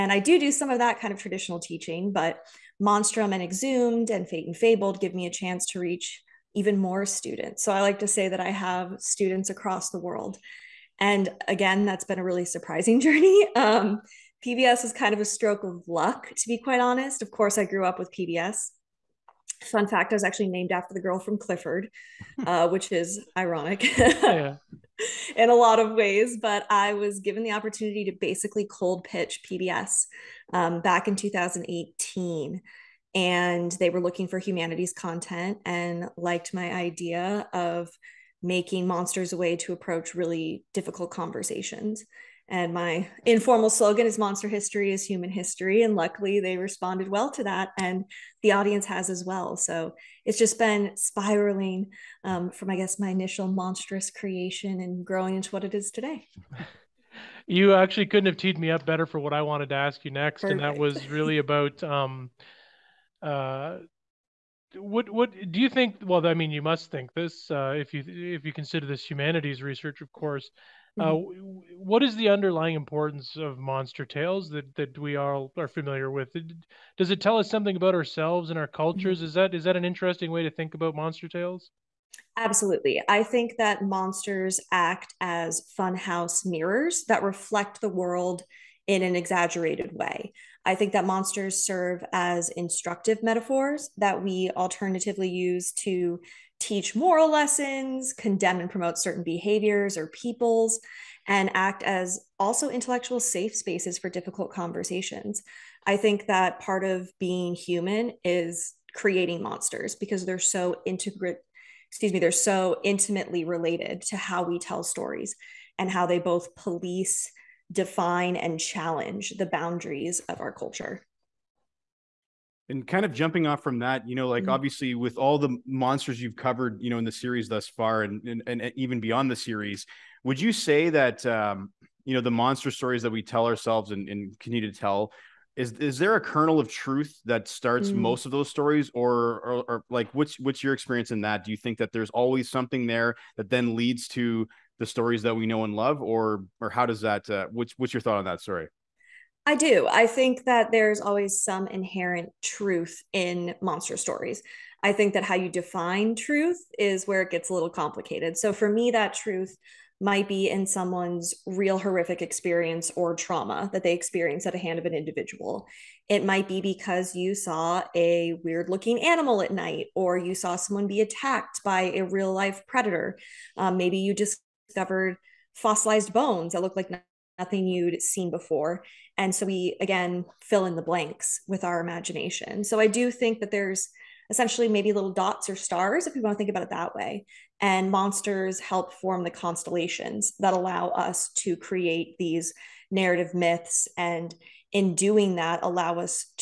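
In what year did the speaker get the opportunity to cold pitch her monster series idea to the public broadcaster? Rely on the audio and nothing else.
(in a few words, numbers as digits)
2018.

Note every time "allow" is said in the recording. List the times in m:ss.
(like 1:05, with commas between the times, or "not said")
3:10, 3:15.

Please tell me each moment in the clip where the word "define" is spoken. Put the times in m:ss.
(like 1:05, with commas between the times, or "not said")
1:57, 2:35.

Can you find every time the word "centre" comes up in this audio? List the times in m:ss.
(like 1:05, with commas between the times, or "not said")
not said.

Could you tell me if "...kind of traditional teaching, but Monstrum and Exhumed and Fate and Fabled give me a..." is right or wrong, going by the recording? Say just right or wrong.
right.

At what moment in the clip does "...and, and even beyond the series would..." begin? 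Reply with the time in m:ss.
2:08.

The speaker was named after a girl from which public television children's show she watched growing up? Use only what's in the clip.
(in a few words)
Clifford.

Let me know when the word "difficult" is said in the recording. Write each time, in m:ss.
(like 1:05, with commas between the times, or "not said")
0:40, 1:44.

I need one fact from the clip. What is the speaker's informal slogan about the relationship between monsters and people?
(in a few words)
Monster History is Human History.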